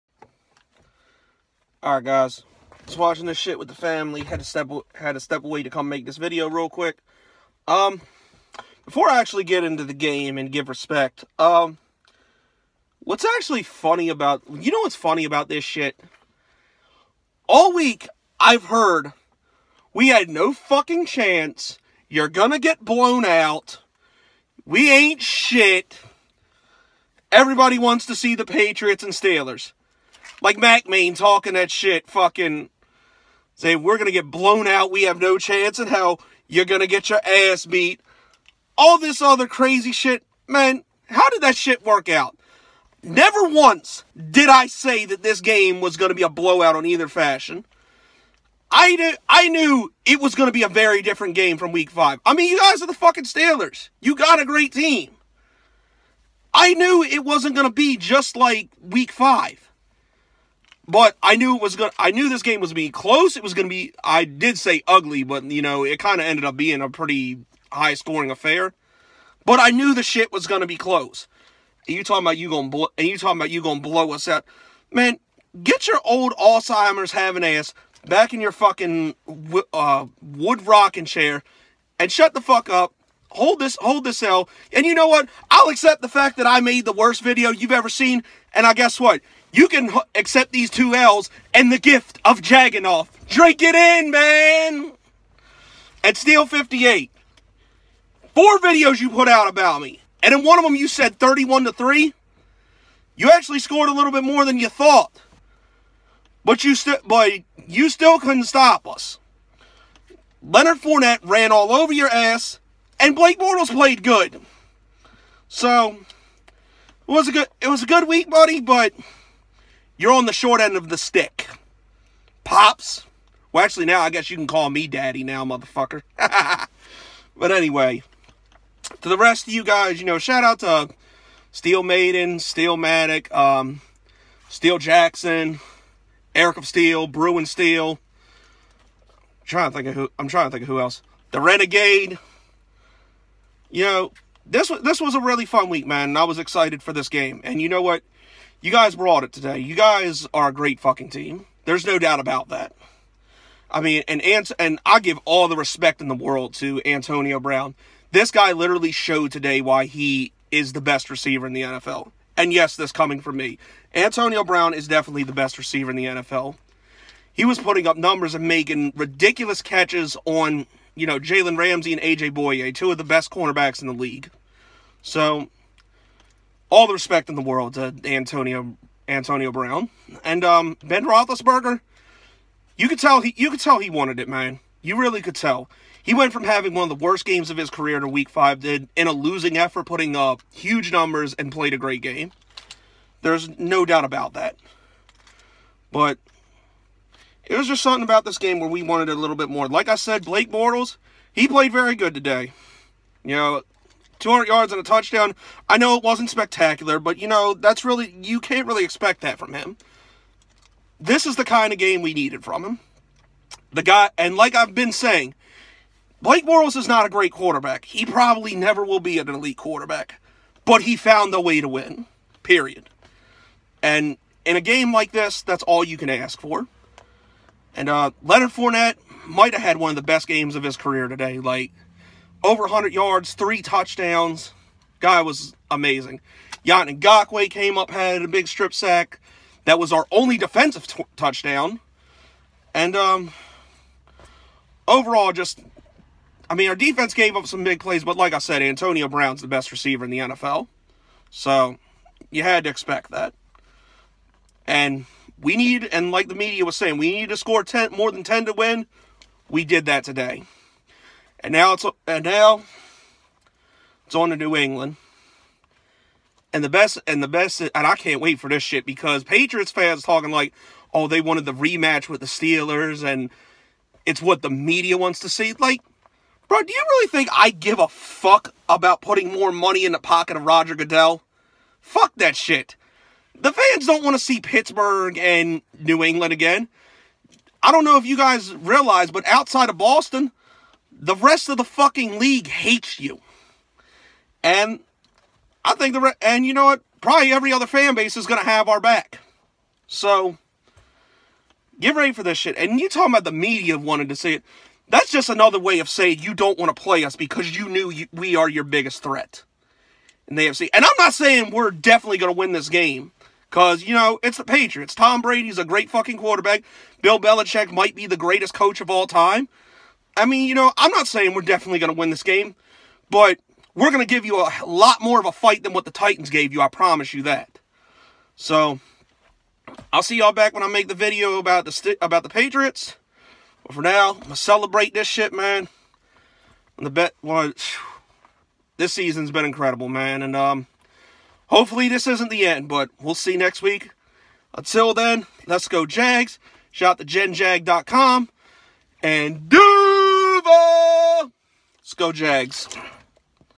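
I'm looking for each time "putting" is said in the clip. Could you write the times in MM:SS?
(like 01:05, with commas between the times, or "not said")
02:47, 03:09, 04:39.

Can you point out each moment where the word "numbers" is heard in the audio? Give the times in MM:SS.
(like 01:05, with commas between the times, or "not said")
02:47, 03:10.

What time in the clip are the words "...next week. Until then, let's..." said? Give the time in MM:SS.
05:43.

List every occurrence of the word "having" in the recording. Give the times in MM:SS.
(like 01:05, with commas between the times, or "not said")
01:17, 03:06.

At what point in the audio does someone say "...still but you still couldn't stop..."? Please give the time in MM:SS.
01:46.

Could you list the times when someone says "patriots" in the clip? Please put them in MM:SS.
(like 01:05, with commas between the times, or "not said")
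00:28, 04:29, 05:14, 05:32.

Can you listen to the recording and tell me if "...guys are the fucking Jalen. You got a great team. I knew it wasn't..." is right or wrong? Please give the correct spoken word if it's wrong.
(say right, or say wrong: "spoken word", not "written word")
wrong: "Steelers", not "Jalen".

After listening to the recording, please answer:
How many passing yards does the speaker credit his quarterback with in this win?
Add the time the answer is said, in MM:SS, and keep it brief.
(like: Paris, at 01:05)
200, at 03:24.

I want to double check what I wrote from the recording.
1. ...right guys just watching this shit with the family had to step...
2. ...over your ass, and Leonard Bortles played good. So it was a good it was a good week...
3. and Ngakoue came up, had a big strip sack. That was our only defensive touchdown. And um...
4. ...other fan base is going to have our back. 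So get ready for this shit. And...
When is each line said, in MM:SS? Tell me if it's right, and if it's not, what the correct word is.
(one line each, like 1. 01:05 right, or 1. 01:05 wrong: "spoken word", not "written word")
1. 00:01 right
2. 01:51 wrong: "Blake", not "Leonard"
3. 03:56 right
4. 04:57 right.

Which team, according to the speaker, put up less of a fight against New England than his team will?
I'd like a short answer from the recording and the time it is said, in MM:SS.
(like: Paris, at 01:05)
the Titans, at 05:25.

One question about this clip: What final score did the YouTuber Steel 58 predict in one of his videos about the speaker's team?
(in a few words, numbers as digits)
31 to 3.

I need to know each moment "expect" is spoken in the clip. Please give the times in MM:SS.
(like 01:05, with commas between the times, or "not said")
03:28, 04:12.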